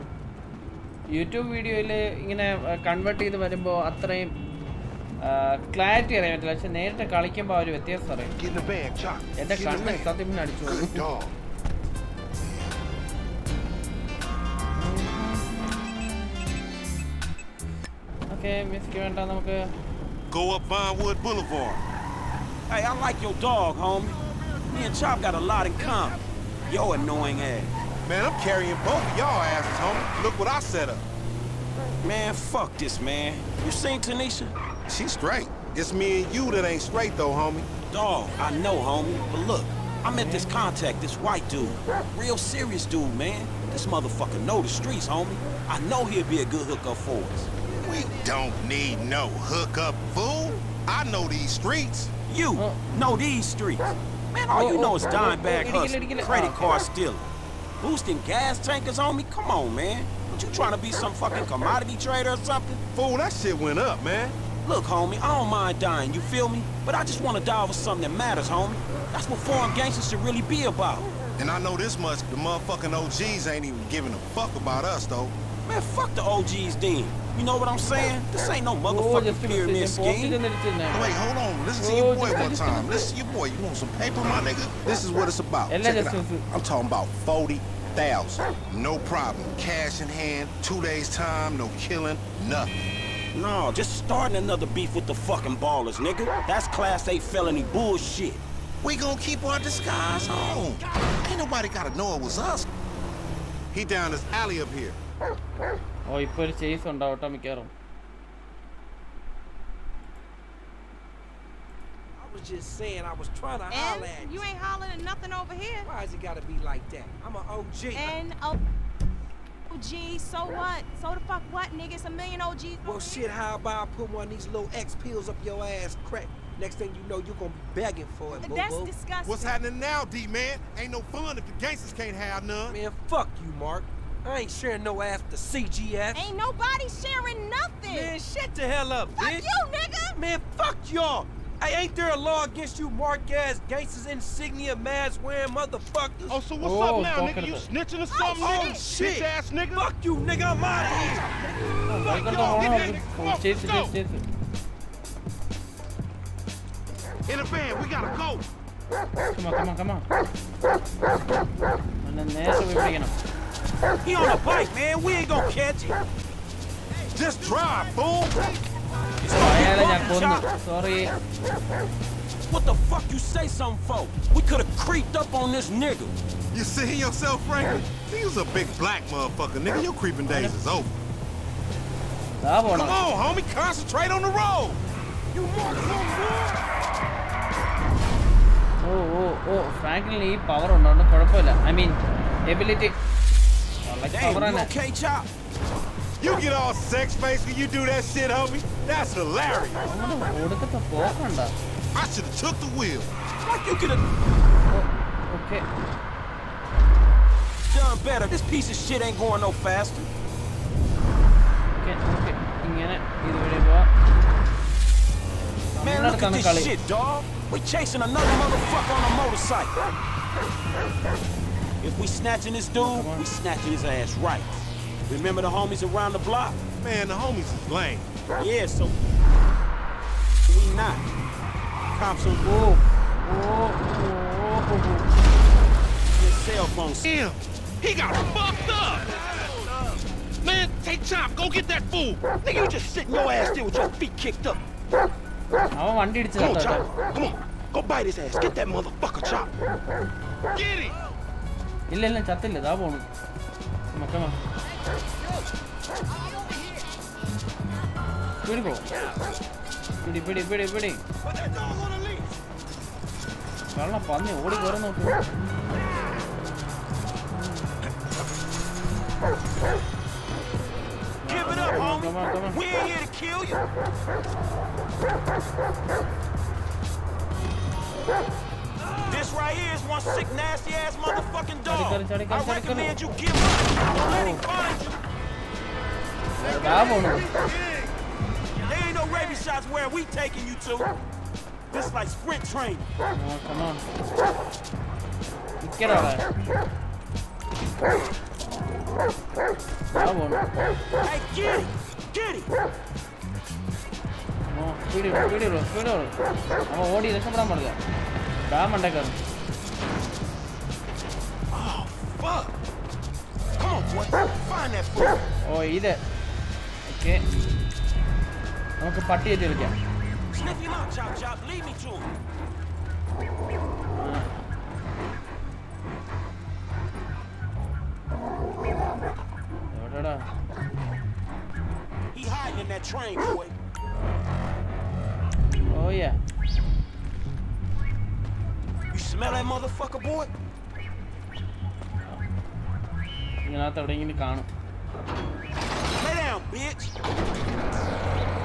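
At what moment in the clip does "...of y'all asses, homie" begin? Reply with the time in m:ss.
0:29.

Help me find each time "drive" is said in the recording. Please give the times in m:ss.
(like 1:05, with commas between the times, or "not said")
2:47.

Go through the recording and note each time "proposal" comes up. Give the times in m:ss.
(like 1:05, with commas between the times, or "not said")
not said.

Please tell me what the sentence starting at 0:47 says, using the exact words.
We don't need no hookup, fool.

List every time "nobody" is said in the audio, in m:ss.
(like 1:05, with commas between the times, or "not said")
1:41, 2:16.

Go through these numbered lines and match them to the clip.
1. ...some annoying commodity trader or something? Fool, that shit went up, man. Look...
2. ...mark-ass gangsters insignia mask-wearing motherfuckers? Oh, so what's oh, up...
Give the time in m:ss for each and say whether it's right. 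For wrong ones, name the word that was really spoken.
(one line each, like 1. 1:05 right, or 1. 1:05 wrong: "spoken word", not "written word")
1. 1:00 wrong: "fucking", not "annoying"
2. 2:22 right.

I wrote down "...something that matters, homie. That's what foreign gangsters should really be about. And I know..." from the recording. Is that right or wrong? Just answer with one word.
right.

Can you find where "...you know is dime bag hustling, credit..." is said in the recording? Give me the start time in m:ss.
0:54.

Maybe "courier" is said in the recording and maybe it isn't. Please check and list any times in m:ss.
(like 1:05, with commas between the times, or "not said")
not said.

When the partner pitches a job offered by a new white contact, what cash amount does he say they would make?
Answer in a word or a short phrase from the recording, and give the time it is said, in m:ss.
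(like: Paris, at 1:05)
40,000, at 1:27.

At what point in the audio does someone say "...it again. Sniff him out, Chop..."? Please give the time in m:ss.
5:19.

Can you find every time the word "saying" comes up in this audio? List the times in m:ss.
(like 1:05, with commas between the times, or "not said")
1:17, 1:52.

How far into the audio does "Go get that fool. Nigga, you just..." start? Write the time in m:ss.
4:01.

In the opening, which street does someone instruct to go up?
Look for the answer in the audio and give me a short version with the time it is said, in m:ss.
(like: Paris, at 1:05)
Vinewood Boulevard, at 0:20.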